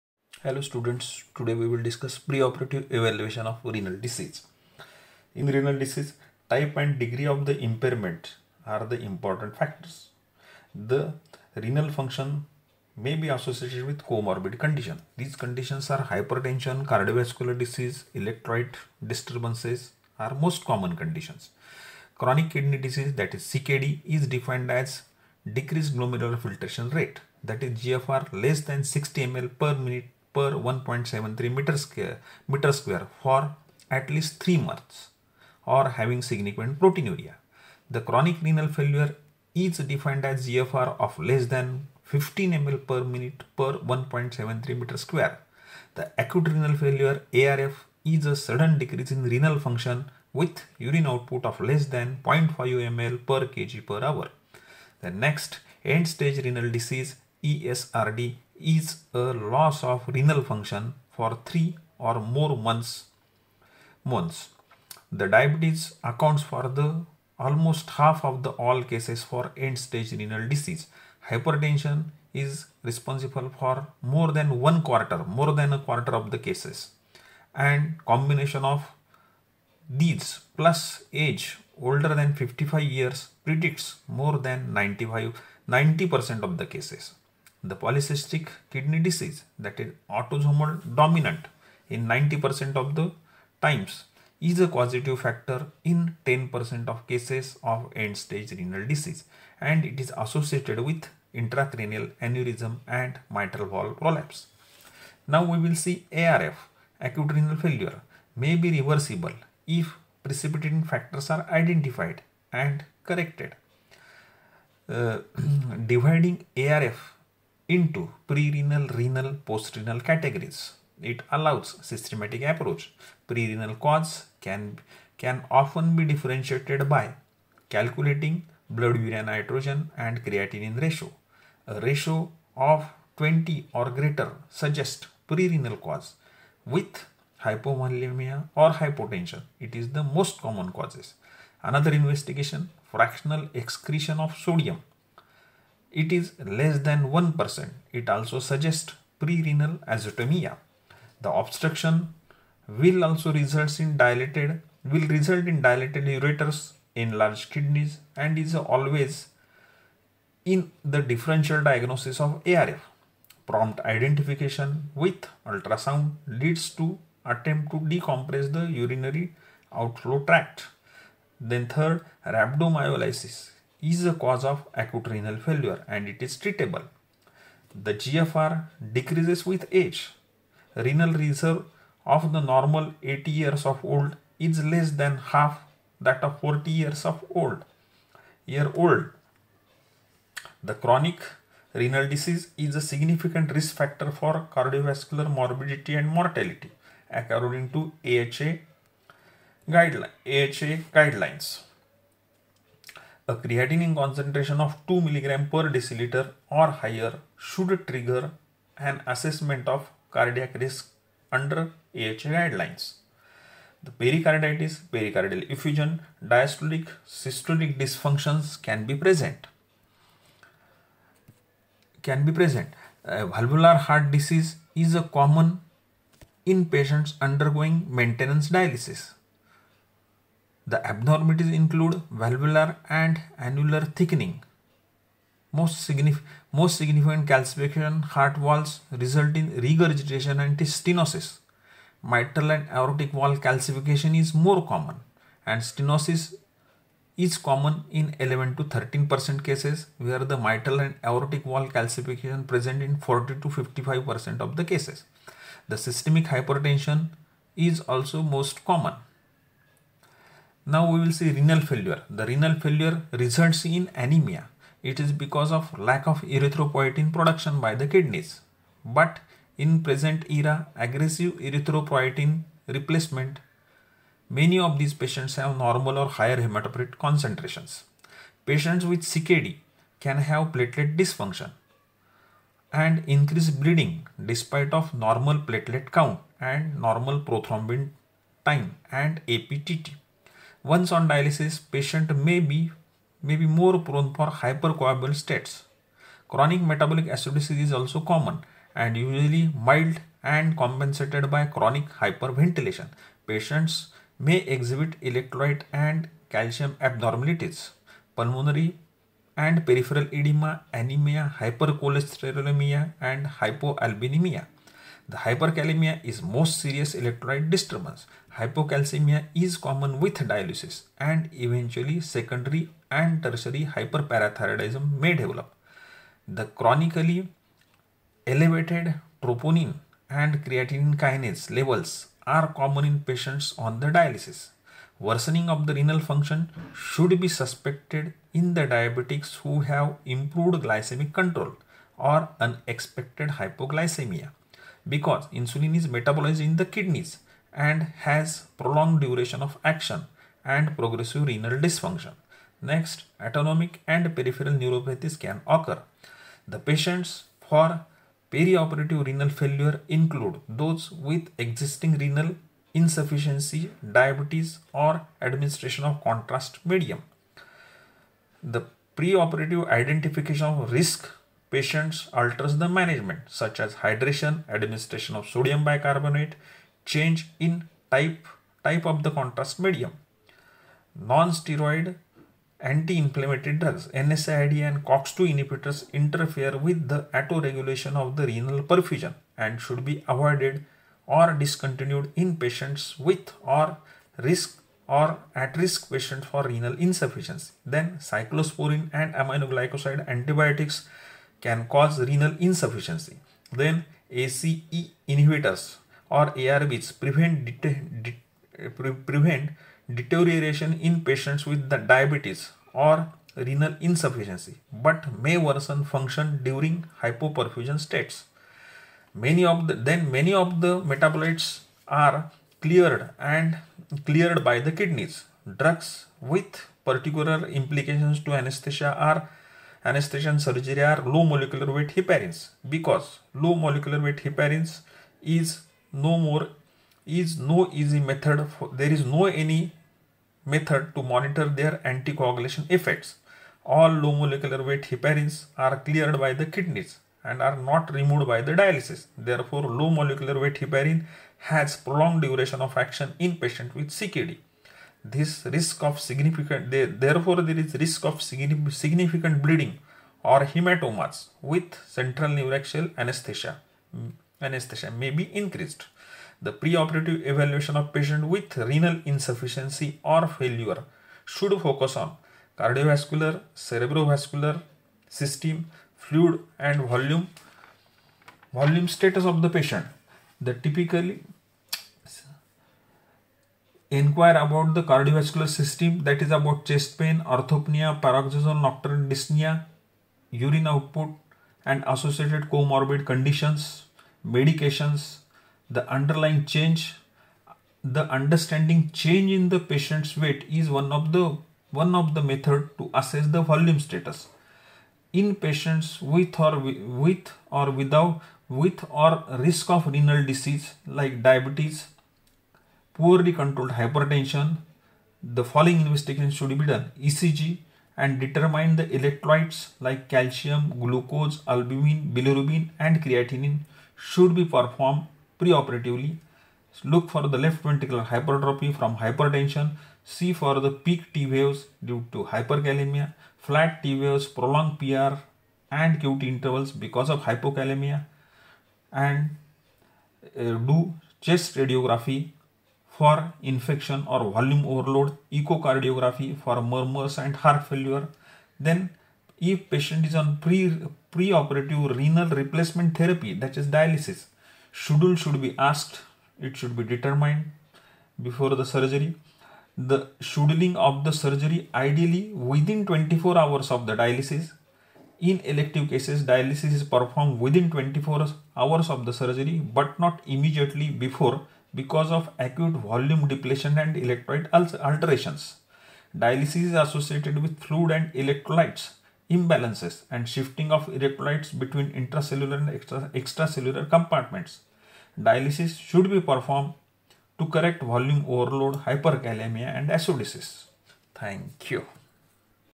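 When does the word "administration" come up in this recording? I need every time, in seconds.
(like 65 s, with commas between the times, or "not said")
365 s, 374 s.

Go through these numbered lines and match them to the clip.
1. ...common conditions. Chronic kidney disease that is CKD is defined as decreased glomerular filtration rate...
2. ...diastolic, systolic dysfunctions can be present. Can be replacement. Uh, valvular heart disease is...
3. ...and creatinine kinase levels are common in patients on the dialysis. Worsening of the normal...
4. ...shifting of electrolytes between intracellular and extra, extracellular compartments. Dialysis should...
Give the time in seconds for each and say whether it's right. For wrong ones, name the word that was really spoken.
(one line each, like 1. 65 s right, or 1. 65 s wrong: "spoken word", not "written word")
1. 20 s right
2. 216 s wrong: "present", not "replacement"
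3. 330 s wrong: "renal", not "normal"
4. 580 s right.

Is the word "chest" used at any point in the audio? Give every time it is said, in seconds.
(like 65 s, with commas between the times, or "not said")
486 s, 541 s.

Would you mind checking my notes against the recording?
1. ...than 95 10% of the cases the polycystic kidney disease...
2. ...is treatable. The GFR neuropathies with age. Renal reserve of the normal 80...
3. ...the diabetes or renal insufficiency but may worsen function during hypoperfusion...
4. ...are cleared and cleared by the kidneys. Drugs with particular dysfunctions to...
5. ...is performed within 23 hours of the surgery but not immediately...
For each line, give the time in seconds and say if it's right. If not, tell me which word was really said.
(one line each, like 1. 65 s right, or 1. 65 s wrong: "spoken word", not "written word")
1. 84 s wrong: "90", not "10"
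2. 176 s wrong: "decreases", not "neuropathies"
3. 411 s right
4. 421 s wrong: "implications", not "dysfunctions"
5. 566 s wrong: "24", not "23".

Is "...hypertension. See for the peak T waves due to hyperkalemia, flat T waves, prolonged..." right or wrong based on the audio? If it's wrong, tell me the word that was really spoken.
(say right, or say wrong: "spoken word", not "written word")
right.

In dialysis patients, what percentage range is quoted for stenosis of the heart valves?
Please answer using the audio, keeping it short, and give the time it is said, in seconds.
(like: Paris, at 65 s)
11 to 13 percent, at 248 s.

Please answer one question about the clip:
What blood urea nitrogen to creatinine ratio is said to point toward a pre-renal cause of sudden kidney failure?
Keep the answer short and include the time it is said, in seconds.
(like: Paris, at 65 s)
20 or greater, at 133 s.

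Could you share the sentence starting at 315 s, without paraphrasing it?
The hyperkalemia is most serious electrolyte disturbance.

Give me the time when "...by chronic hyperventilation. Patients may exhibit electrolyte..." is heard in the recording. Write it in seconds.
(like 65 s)
301 s.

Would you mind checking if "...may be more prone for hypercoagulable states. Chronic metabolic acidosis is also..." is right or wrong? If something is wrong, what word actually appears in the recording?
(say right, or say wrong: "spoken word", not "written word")
right.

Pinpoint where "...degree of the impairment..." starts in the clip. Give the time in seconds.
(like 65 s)
6 s.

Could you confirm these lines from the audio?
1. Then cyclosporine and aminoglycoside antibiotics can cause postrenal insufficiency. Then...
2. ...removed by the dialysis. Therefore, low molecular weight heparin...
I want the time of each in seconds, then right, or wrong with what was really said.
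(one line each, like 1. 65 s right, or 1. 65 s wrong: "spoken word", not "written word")
1. 397 s wrong: "renal", not "postrenal"
2. 447 s right.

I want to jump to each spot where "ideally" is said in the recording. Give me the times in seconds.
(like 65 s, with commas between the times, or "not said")
561 s.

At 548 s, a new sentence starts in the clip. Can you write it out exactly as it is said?
Then if patient is on pre preoperative renal replacement therapy, that is dialysis, schedule should be asked.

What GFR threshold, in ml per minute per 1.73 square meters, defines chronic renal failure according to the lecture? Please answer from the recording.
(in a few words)
15.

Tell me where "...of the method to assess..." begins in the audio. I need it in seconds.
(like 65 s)
501 s.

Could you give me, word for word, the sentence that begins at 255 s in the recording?
The systemic hypertension is also most common.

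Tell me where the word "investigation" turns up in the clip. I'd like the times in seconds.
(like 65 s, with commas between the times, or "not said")
141 s, 515 s.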